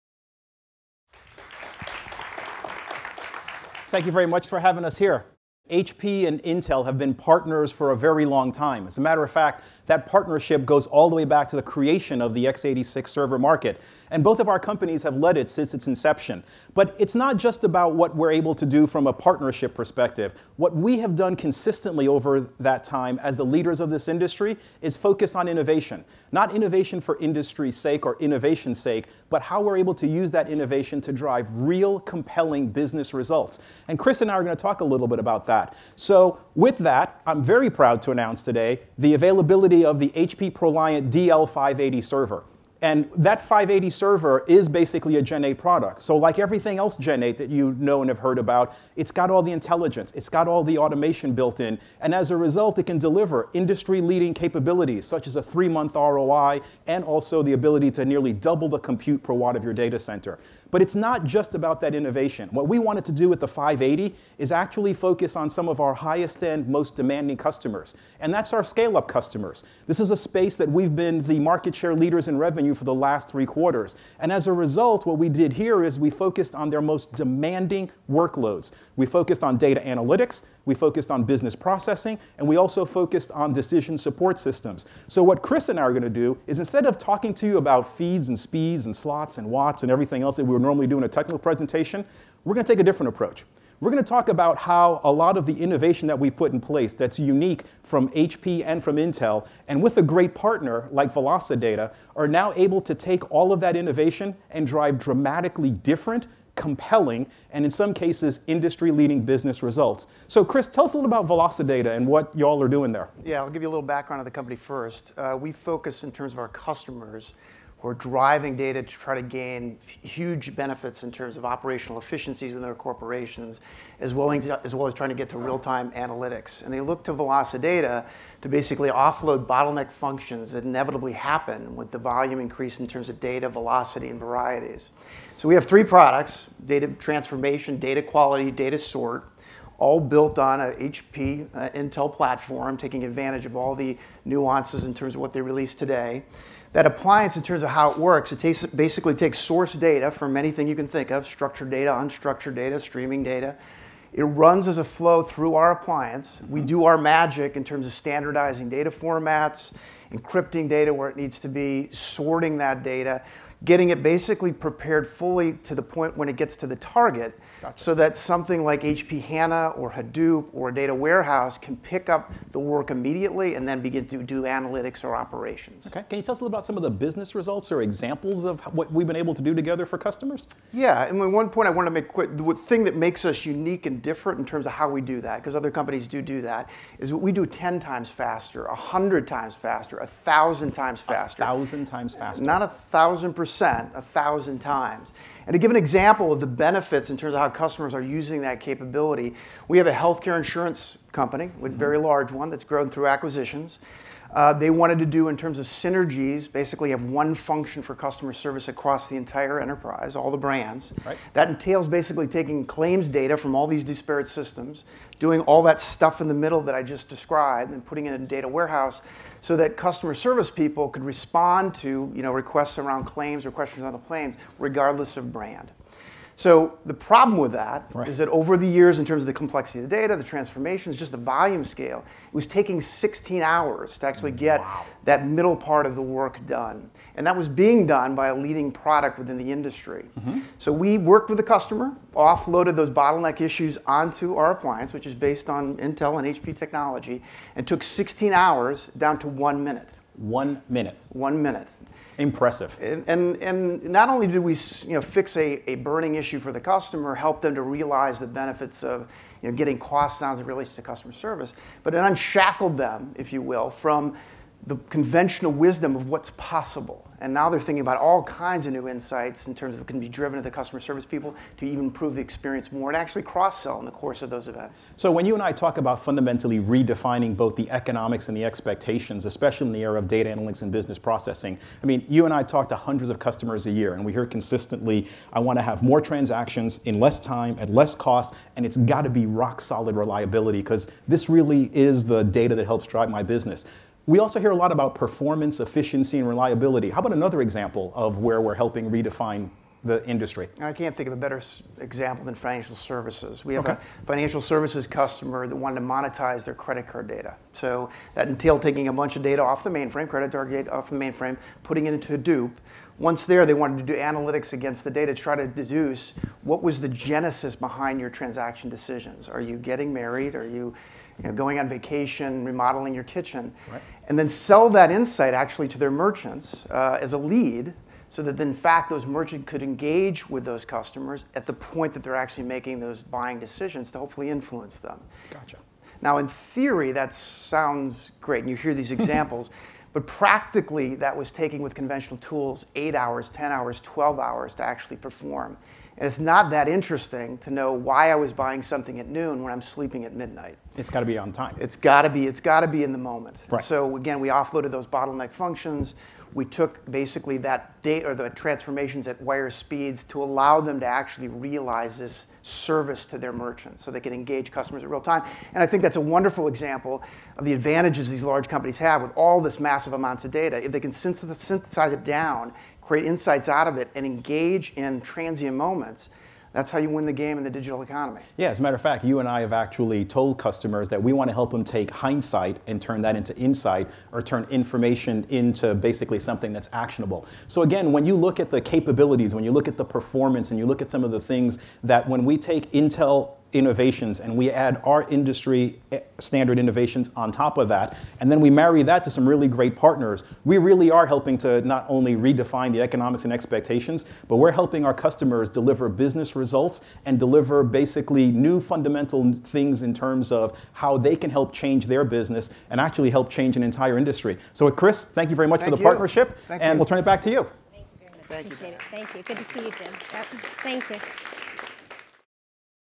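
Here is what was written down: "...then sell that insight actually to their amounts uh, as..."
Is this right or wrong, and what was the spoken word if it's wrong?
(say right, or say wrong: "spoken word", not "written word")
wrong: "merchants", not "amounts".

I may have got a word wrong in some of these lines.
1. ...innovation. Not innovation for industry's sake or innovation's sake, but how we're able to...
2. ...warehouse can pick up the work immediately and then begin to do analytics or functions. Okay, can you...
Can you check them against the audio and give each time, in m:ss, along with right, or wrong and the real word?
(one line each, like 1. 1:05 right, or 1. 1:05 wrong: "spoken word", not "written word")
1. 0:25 right
2. 2:50 wrong: "operations", not "functions".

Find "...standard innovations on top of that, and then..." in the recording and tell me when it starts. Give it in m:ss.
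6:36.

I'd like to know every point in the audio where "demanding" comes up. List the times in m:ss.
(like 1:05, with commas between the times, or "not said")
1:06, 1:17.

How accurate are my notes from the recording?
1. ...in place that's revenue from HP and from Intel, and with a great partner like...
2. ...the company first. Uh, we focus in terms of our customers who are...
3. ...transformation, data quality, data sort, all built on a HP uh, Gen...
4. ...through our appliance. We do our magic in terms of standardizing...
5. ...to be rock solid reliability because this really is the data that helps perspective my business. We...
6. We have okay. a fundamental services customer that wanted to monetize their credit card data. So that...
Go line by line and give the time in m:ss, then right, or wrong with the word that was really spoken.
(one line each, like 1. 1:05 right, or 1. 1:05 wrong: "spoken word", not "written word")
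1. 1:36 wrong: "unique", not "revenue"
2. 1:54 right
3. 2:16 wrong: "Intel", not "Gen"
4. 2:35 right
5. 4:49 wrong: "drive", not "perspective"
6. 5:03 wrong: "financial", not "fundamental".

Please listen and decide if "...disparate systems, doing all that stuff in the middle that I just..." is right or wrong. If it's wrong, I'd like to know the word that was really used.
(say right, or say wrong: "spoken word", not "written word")
right.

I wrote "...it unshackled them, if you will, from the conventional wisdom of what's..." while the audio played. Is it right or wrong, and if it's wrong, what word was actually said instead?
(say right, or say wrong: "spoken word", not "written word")
right.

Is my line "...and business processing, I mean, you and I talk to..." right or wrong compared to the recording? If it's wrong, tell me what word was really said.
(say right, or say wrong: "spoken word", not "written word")
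right.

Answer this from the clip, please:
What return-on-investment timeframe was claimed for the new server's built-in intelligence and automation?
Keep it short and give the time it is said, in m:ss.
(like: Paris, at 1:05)
three-month, at 0:55.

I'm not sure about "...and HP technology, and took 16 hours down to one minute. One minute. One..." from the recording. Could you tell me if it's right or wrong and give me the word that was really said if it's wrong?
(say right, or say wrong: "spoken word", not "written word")
right.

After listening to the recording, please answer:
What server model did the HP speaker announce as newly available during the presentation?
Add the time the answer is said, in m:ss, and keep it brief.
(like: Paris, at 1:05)
HP ProLiant DL580, at 0:40.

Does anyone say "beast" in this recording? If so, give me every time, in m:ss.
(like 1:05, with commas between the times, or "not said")
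not said.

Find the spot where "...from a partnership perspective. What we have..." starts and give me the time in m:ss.
0:18.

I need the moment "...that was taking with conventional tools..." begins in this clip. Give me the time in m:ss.
5:40.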